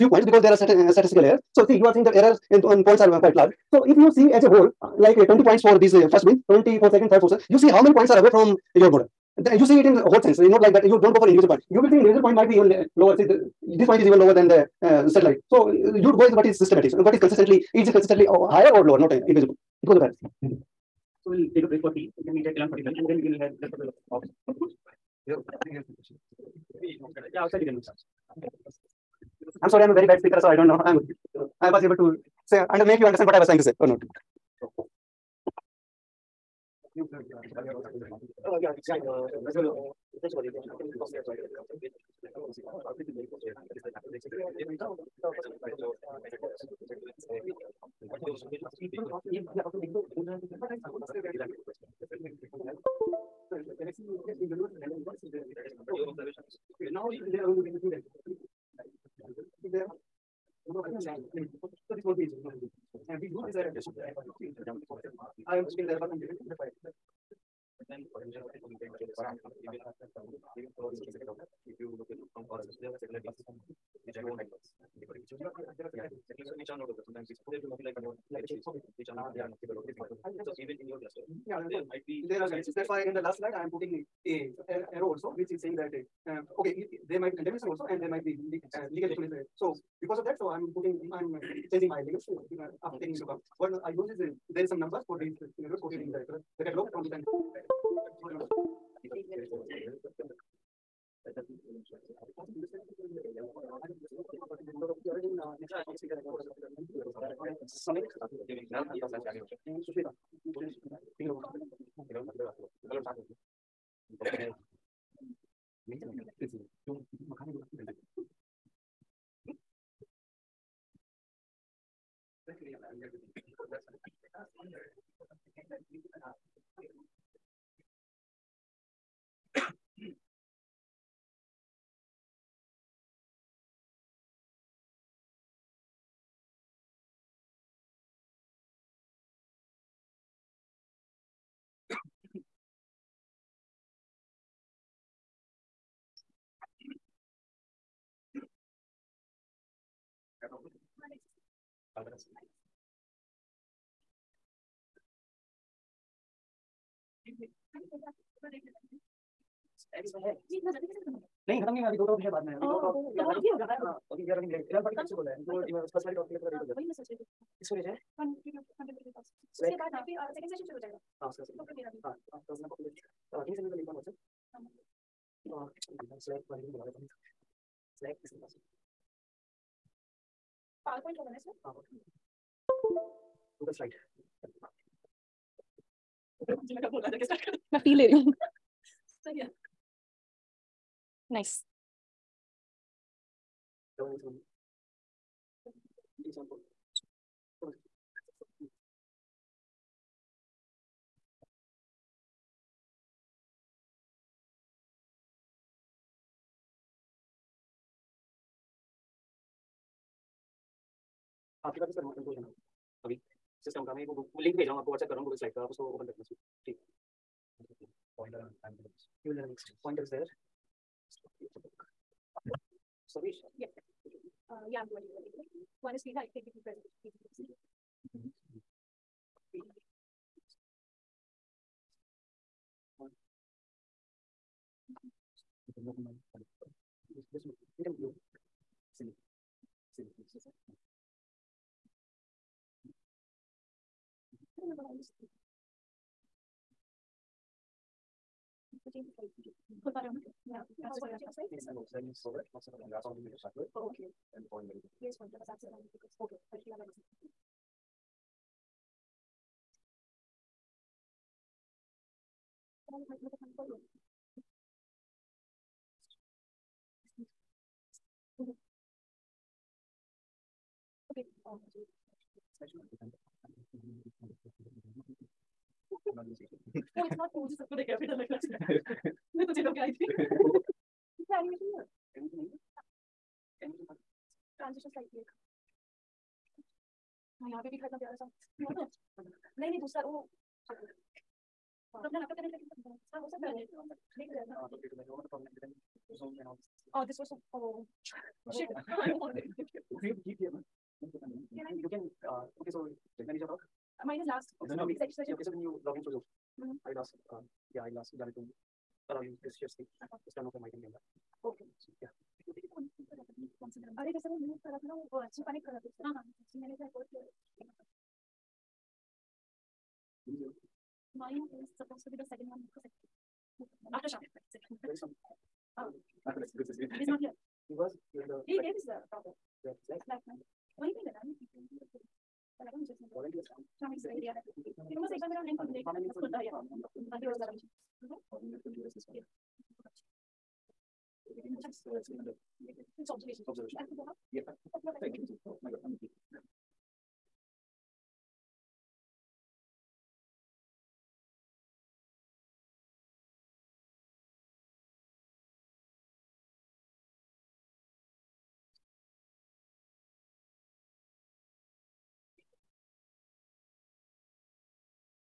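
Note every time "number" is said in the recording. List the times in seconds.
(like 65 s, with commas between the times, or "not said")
60 s, 94 s.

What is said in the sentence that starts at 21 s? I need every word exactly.
So we'll take a break for tea.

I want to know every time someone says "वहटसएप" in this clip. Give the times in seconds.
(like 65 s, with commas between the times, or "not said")
173 s, 214 s.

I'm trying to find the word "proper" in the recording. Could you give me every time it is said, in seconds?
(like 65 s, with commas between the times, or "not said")
329 s.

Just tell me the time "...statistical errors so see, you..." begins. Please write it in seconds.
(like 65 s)
0 s.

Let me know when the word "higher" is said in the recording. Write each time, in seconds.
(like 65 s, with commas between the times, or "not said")
18 s.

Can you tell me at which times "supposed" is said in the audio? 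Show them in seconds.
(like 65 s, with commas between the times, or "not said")
321 s.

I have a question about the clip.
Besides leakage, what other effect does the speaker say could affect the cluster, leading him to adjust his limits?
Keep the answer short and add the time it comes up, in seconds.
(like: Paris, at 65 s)
contamination, at 87 s.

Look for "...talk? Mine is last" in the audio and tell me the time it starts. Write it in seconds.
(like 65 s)
303 s.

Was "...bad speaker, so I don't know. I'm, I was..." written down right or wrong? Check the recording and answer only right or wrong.
right.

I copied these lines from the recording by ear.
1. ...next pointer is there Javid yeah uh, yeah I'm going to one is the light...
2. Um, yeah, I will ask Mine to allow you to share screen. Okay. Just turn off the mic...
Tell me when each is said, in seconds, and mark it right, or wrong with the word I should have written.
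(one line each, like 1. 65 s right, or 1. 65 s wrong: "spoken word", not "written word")
1. 219 s wrong: "Savish", not "Javid"
2. 307 s wrong: "Javid", not "Mine".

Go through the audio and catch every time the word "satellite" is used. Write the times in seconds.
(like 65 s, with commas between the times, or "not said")
15 s, 73 s.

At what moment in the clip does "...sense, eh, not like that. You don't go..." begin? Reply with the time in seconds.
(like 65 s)
10 s.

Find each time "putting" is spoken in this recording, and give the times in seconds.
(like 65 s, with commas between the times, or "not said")
83 s, 90 s.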